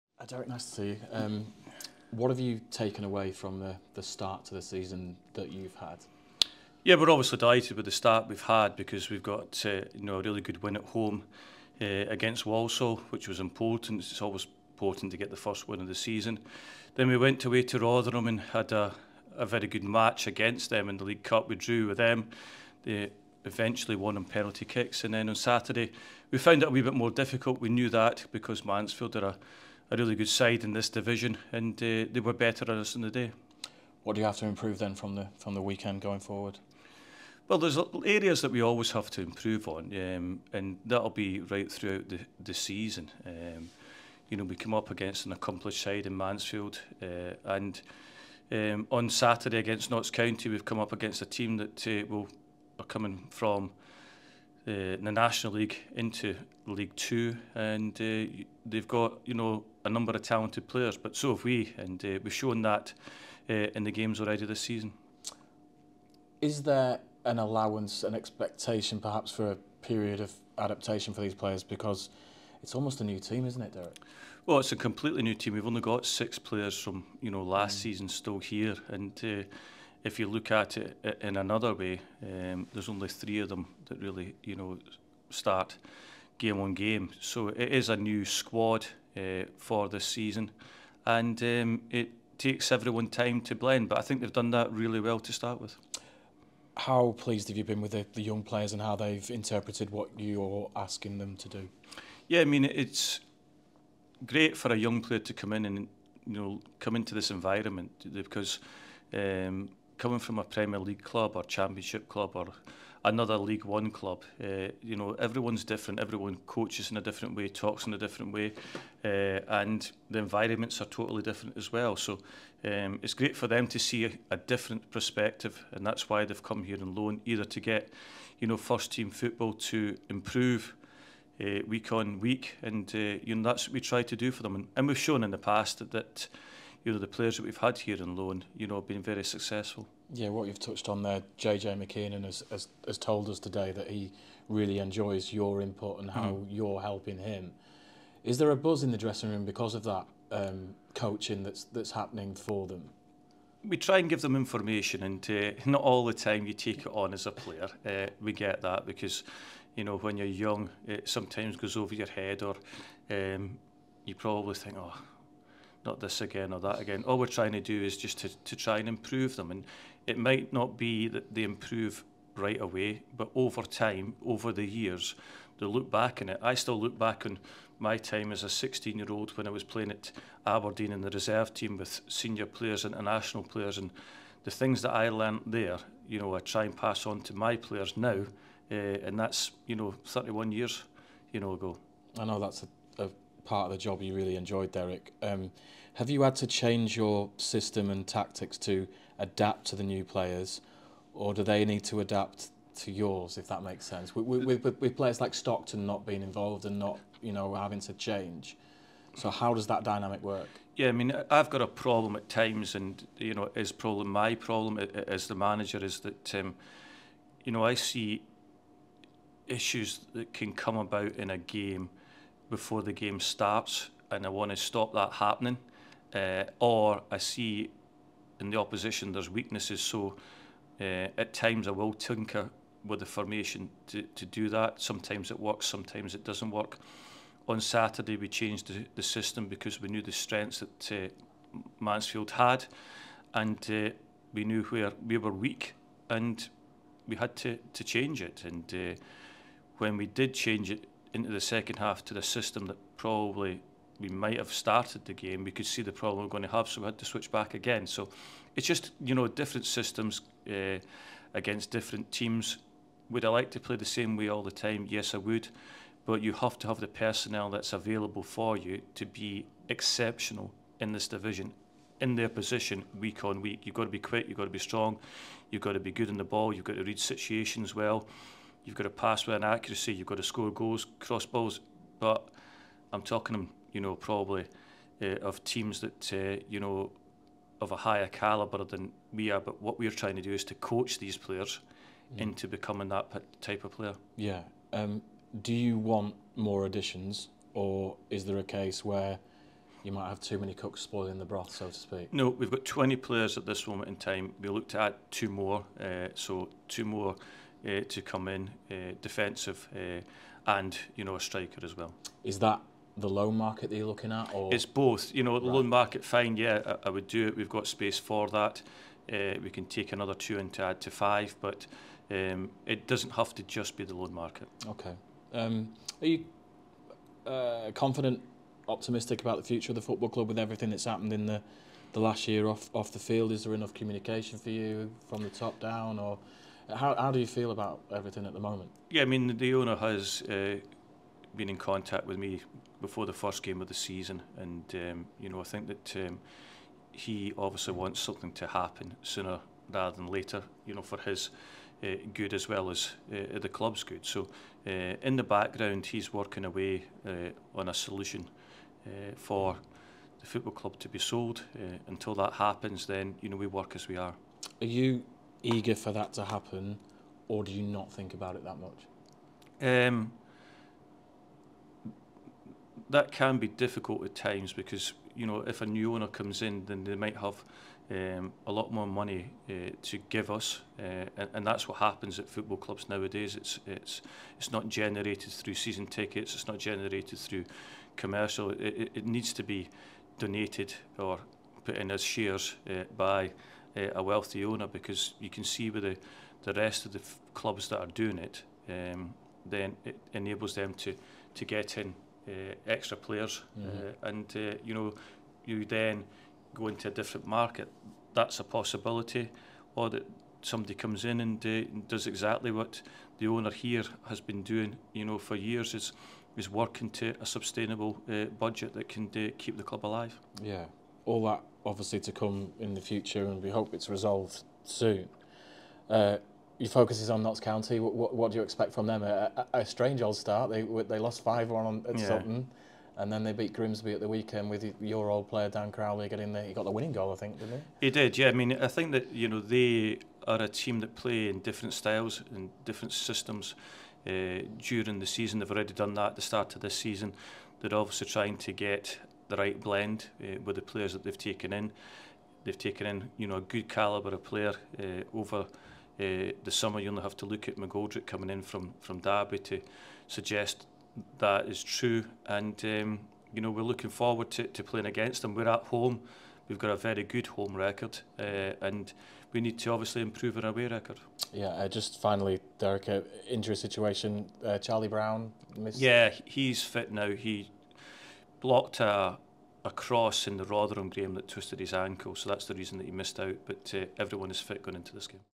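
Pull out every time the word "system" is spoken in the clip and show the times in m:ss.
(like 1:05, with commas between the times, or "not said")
3:17, 3:59, 4:12, 4:19, 7:22.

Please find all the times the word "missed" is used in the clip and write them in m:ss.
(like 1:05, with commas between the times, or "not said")
7:55, 8:02.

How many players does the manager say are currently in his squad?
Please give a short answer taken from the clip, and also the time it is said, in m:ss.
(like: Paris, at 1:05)
20, at 5:02.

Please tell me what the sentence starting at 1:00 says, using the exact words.
But so have we, and uh, we've shown that uh, in the games already this season.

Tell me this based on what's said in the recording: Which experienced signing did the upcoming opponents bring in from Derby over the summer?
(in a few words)
McGoldrick.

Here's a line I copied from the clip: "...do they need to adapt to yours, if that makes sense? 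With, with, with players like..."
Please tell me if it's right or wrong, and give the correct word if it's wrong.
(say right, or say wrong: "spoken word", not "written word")
right.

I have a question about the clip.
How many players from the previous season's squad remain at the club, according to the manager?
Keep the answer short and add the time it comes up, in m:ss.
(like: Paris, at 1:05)
6, at 1:16.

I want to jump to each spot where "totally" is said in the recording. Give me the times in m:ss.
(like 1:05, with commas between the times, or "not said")
2:00.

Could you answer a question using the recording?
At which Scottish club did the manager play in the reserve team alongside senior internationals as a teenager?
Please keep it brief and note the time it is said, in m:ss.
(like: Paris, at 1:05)
Aberdeen, at 3:00.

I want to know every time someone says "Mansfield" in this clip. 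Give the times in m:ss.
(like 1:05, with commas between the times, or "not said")
0:28, 0:46, 4:01.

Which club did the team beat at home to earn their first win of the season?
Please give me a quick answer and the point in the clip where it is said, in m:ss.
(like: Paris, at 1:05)
Walsall, at 0:12.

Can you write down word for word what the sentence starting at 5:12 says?
Is that the loan market that you're looking at, or it's both?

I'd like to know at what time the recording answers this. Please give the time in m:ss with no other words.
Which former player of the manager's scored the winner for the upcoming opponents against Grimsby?
7:15.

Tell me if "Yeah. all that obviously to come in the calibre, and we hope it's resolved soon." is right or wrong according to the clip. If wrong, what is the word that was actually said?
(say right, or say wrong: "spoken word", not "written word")
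wrong: "future", not "calibre".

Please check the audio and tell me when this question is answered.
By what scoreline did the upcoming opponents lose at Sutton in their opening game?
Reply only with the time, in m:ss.
7:11.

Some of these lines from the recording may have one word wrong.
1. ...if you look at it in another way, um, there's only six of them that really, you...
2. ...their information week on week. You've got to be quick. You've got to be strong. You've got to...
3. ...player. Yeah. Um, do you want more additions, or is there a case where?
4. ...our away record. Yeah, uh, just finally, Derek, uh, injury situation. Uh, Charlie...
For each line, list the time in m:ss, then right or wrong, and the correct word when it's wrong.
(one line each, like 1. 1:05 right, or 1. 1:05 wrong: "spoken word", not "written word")
1. 1:20 wrong: "three", not "six"
2. 4:32 wrong: "position", not "information"
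3. 4:53 right
4. 7:50 right.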